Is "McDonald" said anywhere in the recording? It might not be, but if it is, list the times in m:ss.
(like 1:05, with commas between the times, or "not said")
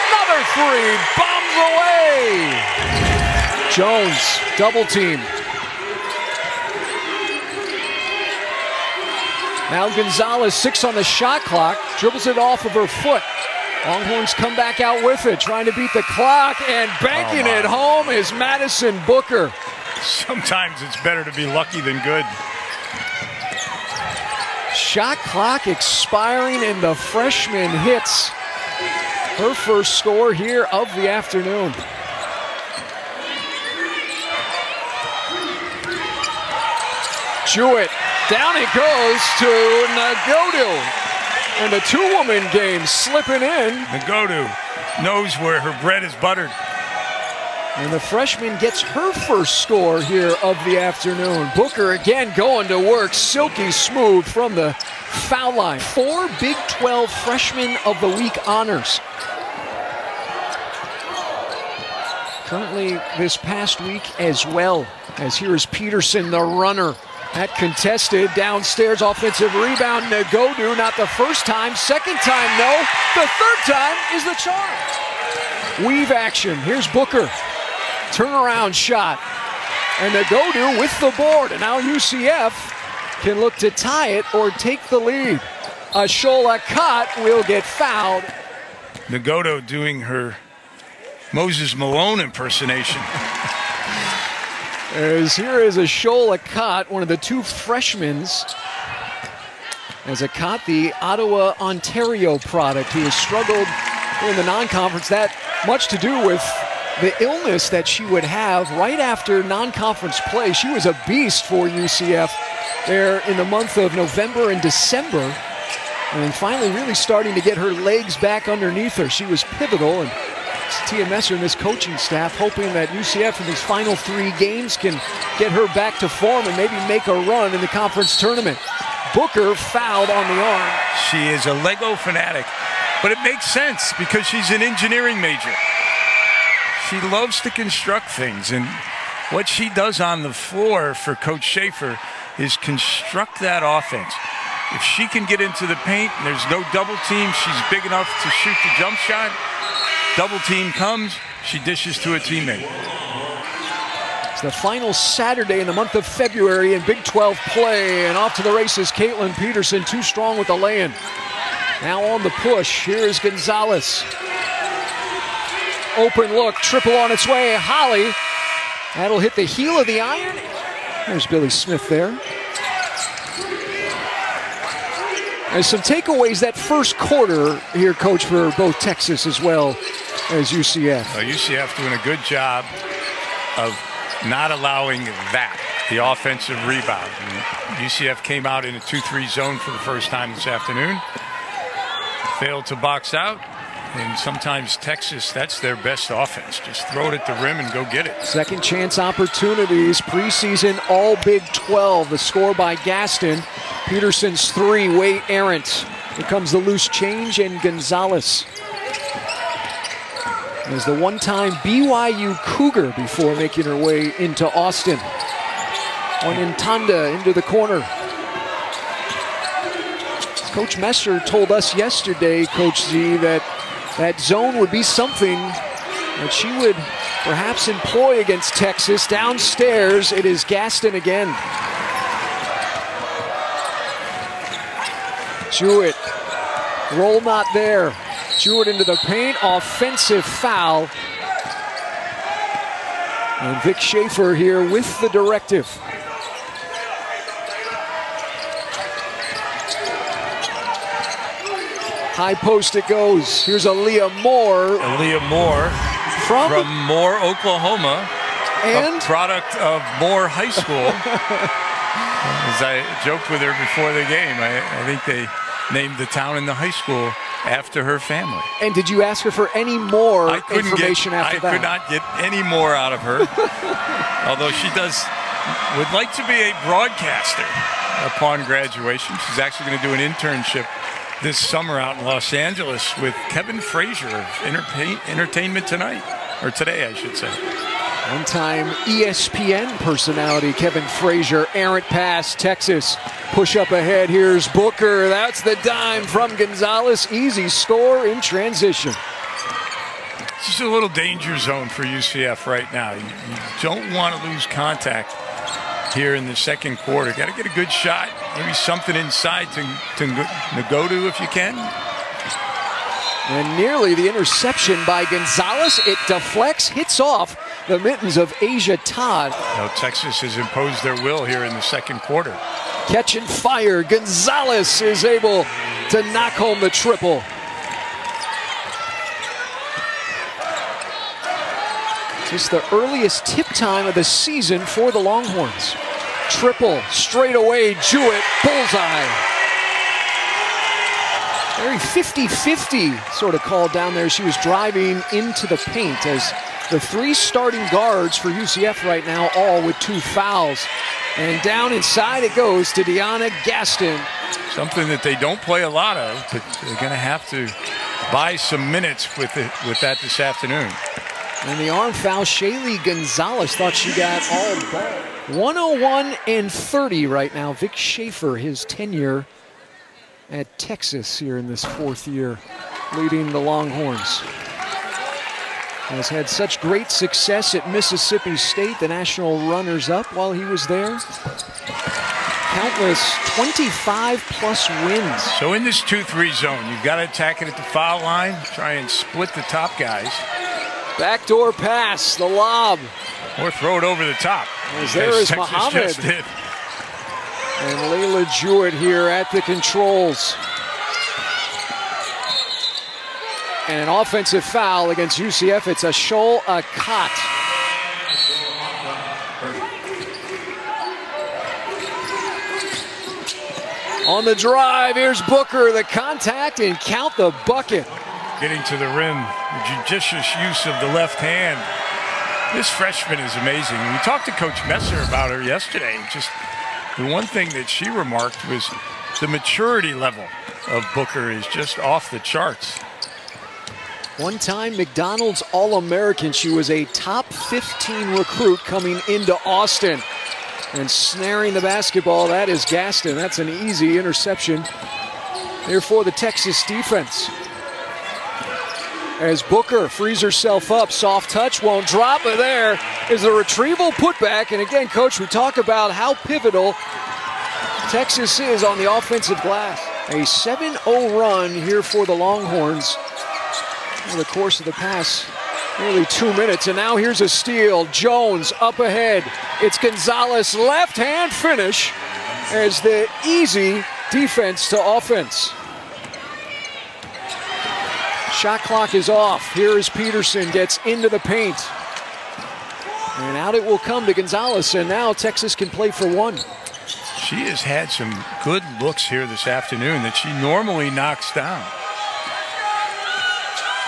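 7:14.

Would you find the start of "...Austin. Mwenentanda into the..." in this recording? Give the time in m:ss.
3:34.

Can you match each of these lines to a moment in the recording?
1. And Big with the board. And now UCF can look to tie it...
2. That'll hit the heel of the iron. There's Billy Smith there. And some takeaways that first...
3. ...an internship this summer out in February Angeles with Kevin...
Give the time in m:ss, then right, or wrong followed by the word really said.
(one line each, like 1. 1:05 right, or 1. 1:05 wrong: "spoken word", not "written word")
1. 1:20 wrong: "Nagodu", not "Big"
2. 2:48 right
3. 4:39 wrong: "Los", not "February".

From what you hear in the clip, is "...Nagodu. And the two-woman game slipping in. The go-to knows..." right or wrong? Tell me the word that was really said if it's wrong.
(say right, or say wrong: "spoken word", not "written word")
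right.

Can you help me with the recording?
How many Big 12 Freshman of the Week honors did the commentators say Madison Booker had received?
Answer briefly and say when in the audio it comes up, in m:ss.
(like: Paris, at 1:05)
4, at 0:55.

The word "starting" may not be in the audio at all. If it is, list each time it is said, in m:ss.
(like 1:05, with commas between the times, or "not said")
1:56, 5:47.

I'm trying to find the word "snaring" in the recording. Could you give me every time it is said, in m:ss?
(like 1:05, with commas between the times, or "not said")
7:20.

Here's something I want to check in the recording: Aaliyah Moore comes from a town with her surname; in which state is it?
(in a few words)
Oklahoma.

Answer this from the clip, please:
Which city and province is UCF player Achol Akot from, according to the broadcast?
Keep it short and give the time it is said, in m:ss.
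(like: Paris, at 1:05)
Ottawa, Ontario, at 1:40.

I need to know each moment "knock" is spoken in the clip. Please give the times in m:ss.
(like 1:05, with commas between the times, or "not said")
5:26, 8:10.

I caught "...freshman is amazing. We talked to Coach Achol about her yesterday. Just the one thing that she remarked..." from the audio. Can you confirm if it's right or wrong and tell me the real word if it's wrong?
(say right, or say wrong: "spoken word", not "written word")
wrong: "Messer", not "Achol".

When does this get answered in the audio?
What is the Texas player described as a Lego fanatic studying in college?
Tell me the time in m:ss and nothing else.
2:14.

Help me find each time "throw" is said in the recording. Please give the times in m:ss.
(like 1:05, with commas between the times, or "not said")
3:16, 6:33.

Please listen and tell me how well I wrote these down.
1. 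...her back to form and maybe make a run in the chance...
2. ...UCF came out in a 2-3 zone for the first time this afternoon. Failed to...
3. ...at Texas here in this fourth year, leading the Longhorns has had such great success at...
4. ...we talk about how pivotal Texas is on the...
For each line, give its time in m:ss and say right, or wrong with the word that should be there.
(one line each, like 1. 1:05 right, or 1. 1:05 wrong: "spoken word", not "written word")
1. 2:05 wrong: "conference", not "chance"
2. 3:07 right
3. 6:10 right
4. 7:35 right.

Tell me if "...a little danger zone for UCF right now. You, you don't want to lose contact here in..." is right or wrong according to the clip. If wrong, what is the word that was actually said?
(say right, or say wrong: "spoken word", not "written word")
right.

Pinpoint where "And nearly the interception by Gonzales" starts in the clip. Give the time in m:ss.
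5:13.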